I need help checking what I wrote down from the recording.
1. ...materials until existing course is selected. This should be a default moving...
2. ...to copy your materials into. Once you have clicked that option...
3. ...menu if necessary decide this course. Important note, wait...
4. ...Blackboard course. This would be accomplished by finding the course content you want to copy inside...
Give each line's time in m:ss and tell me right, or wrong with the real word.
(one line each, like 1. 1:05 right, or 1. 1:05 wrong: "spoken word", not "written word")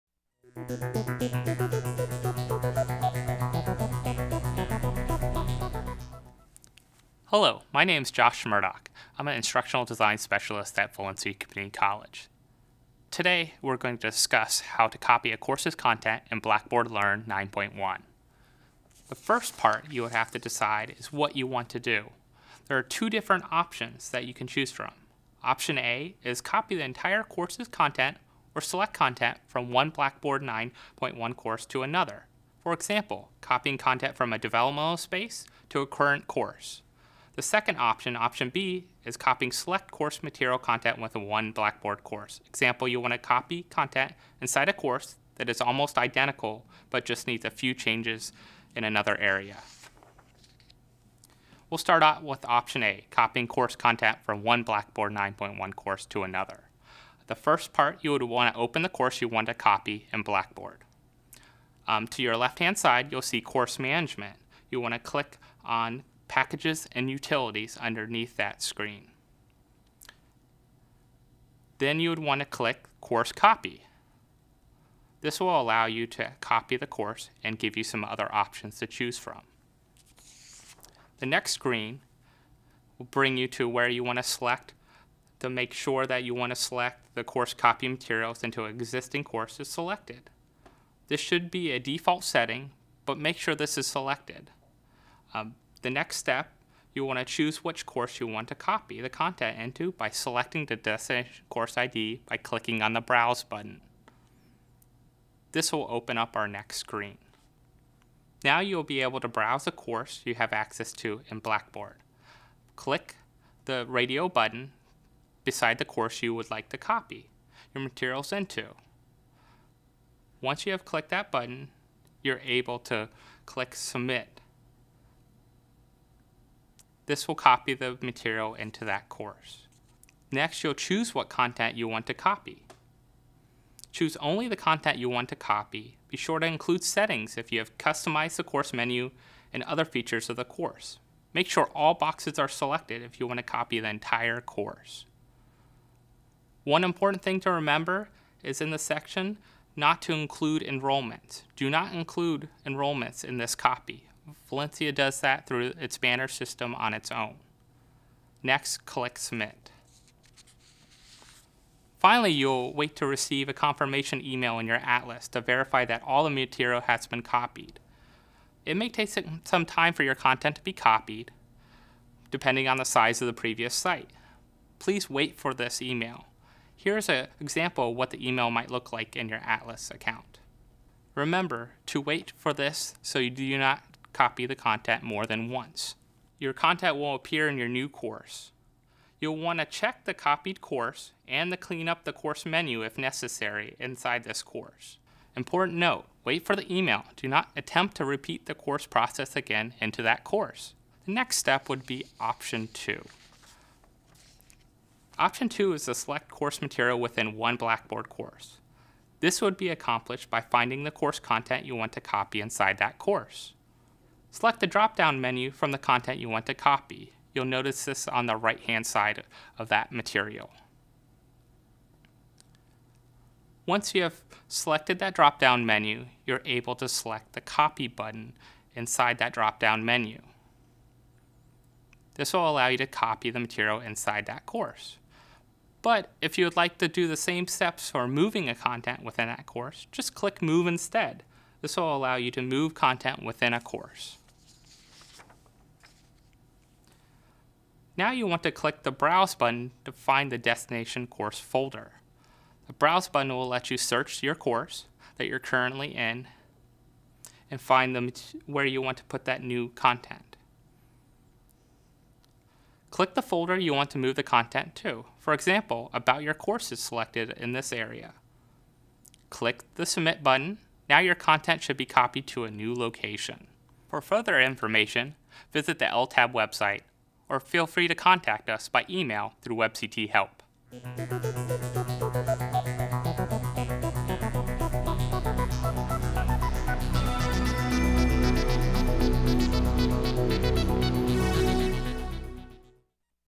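1. 1:27 wrong: "setting", not "moving"
2. 1:56 wrong: "button", not "option"
3. 3:12 wrong: "inside", not "decide"
4. 3:27 right.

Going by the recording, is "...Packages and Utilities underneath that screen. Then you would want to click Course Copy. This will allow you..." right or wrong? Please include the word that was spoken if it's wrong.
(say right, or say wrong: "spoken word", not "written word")
right.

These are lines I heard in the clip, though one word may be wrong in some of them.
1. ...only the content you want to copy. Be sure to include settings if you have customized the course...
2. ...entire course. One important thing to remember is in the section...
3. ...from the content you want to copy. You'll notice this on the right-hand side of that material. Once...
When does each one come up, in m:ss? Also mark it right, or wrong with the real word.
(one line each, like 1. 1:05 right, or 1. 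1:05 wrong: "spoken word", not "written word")
1. 2:14 right
2. 2:23 right
3. 3:35 right.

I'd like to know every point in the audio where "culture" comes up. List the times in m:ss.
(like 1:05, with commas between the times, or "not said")
not said.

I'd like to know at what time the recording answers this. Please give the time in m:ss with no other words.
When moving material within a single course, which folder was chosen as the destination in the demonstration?
4:25.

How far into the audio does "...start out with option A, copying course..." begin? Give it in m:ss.
0:51.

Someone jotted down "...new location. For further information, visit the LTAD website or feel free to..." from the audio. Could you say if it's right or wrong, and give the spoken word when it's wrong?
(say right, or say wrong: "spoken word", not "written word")
right.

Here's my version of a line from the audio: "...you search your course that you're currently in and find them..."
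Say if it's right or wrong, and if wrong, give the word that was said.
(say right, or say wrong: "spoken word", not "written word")
right.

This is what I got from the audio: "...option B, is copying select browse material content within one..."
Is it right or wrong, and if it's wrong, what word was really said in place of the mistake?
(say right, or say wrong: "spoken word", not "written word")
wrong: "course", not "browse".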